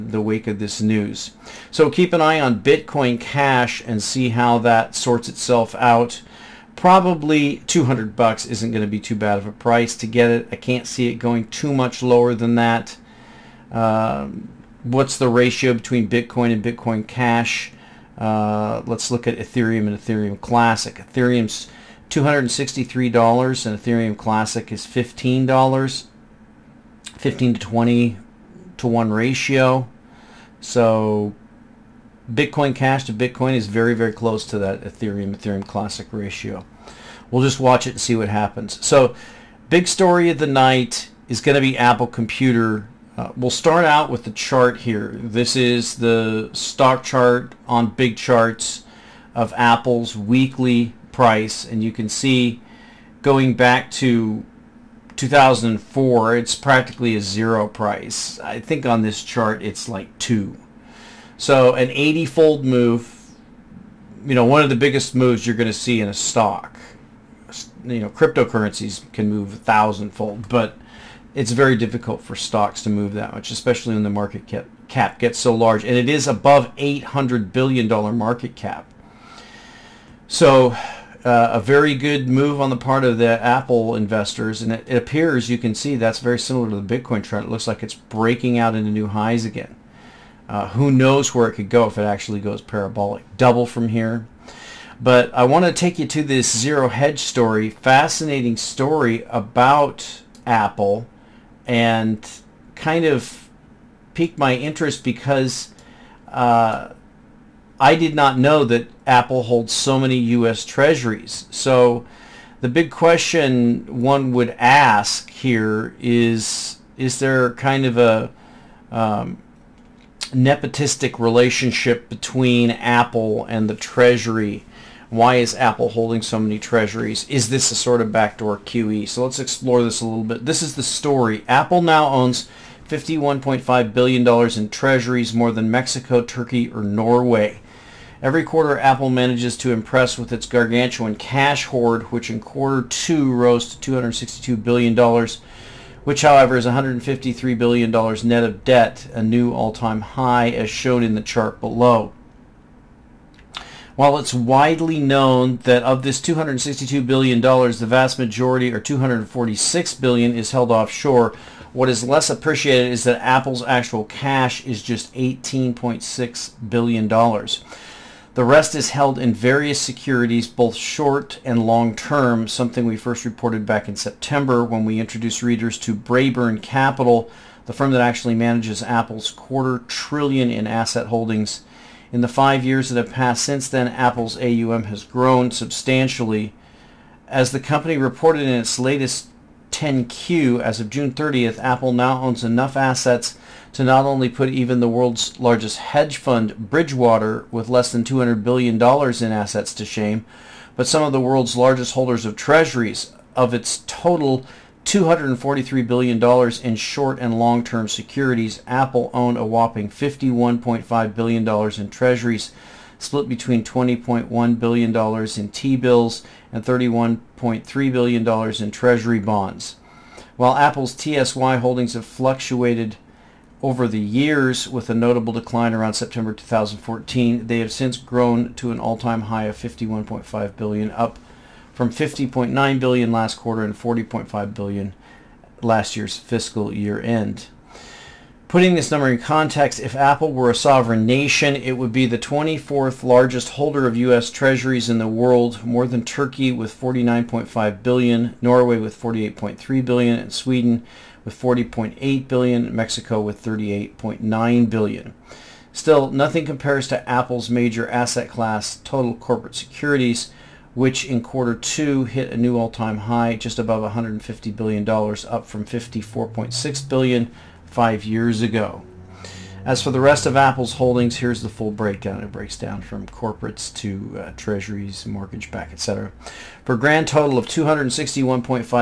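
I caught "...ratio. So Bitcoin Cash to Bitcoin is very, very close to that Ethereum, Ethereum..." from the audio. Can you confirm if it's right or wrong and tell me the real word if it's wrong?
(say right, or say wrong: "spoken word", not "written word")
right.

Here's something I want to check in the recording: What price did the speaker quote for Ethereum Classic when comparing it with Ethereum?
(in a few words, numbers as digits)
$15.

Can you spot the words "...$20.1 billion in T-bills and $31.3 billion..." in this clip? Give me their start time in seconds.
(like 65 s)
213 s.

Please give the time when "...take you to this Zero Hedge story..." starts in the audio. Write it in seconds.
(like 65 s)
95 s.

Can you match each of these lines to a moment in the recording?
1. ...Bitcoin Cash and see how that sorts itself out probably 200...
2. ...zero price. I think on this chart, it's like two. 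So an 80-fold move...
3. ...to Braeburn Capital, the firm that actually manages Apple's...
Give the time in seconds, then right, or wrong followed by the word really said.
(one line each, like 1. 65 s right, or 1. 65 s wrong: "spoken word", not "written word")
1. 2 s right
2. 57 s right
3. 175 s right.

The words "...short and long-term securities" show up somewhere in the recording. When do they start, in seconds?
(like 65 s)
206 s.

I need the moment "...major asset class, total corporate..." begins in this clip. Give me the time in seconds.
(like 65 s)
257 s.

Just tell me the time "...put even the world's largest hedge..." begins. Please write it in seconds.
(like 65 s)
194 s.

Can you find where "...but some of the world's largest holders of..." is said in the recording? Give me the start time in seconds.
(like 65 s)
200 s.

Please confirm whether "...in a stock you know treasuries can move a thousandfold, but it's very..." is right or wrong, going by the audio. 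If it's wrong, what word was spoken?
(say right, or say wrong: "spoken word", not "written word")
wrong: "cryptocurrencies", not "treasuries".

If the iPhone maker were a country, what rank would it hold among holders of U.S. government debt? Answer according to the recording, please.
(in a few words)
24th.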